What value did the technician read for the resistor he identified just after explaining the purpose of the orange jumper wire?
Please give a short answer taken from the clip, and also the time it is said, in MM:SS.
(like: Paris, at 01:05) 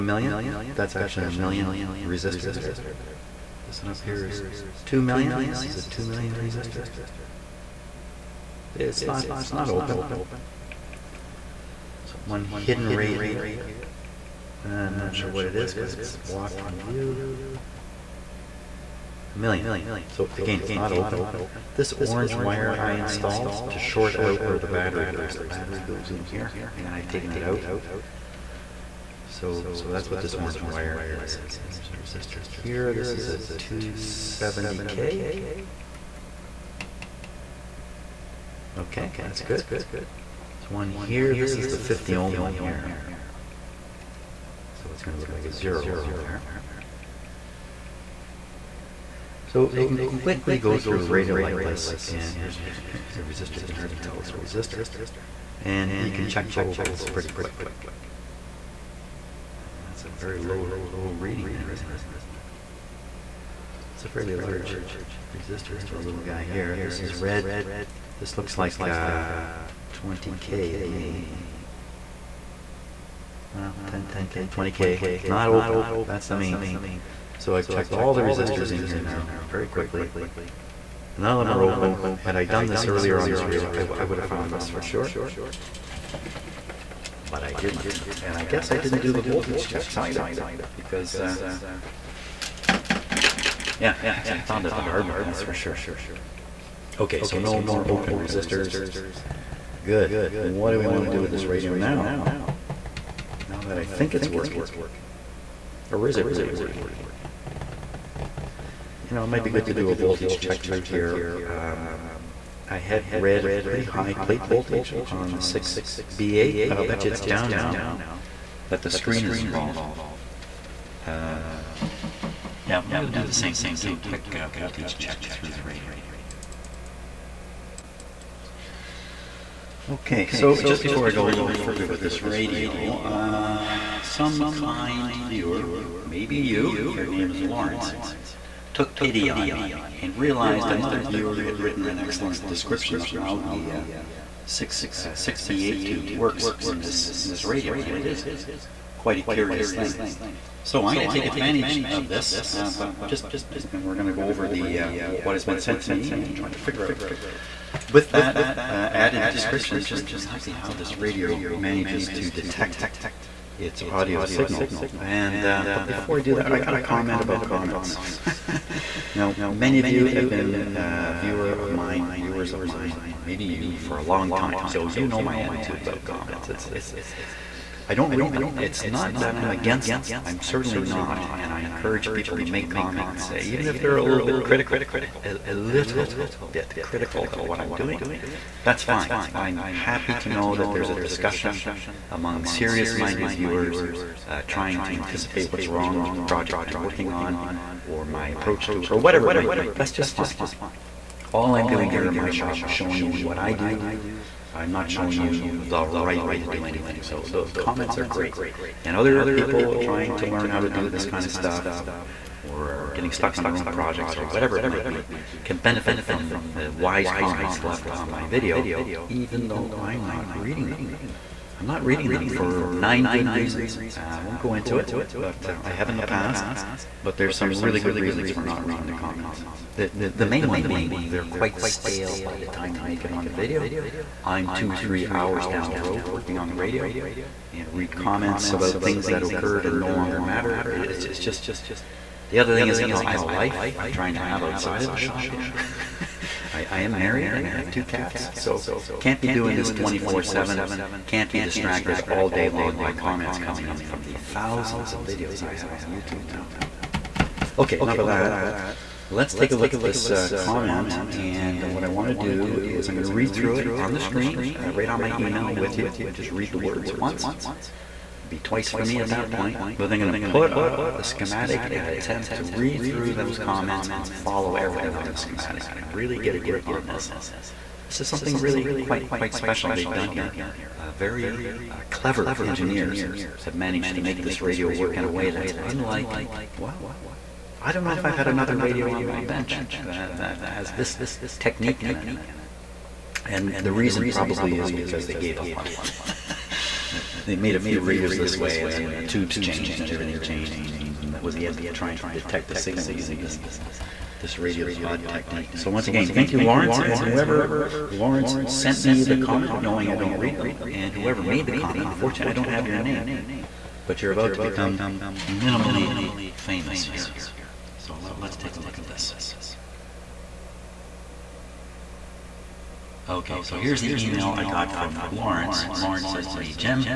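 270K, at 00:33.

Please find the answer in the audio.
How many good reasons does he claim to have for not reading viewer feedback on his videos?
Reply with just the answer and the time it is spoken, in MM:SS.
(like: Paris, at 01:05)
9, at 03:42.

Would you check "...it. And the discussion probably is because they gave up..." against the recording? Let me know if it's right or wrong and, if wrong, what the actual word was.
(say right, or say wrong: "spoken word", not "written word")
wrong: "reason", not "discussion".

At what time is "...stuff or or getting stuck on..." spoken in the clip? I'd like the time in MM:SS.
03:31.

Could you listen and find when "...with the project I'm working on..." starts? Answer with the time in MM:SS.
03:16.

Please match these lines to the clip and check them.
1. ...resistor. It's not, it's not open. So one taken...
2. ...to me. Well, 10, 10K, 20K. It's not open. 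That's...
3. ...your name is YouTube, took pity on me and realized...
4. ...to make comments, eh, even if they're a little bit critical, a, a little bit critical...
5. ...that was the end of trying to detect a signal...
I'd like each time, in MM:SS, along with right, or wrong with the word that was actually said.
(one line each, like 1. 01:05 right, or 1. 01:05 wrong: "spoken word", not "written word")
1. 00:06 wrong: "hidden", not "taken"
2. 01:10 right
3. 02:16 wrong: "Lawrence", not "YouTube"
4. 03:02 right
5. 05:01 right.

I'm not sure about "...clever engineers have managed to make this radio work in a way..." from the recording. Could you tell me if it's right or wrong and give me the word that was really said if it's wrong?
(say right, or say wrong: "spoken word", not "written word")
right.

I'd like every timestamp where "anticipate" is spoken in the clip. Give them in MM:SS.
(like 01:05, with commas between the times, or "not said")
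03:14.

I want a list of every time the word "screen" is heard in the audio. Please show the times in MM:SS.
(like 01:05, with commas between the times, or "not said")
01:58, 04:23.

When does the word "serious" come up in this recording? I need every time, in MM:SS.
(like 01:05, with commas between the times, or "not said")
03:12.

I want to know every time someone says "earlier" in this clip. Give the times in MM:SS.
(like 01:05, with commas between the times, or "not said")
01:22.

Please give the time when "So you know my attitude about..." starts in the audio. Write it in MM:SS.
02:54.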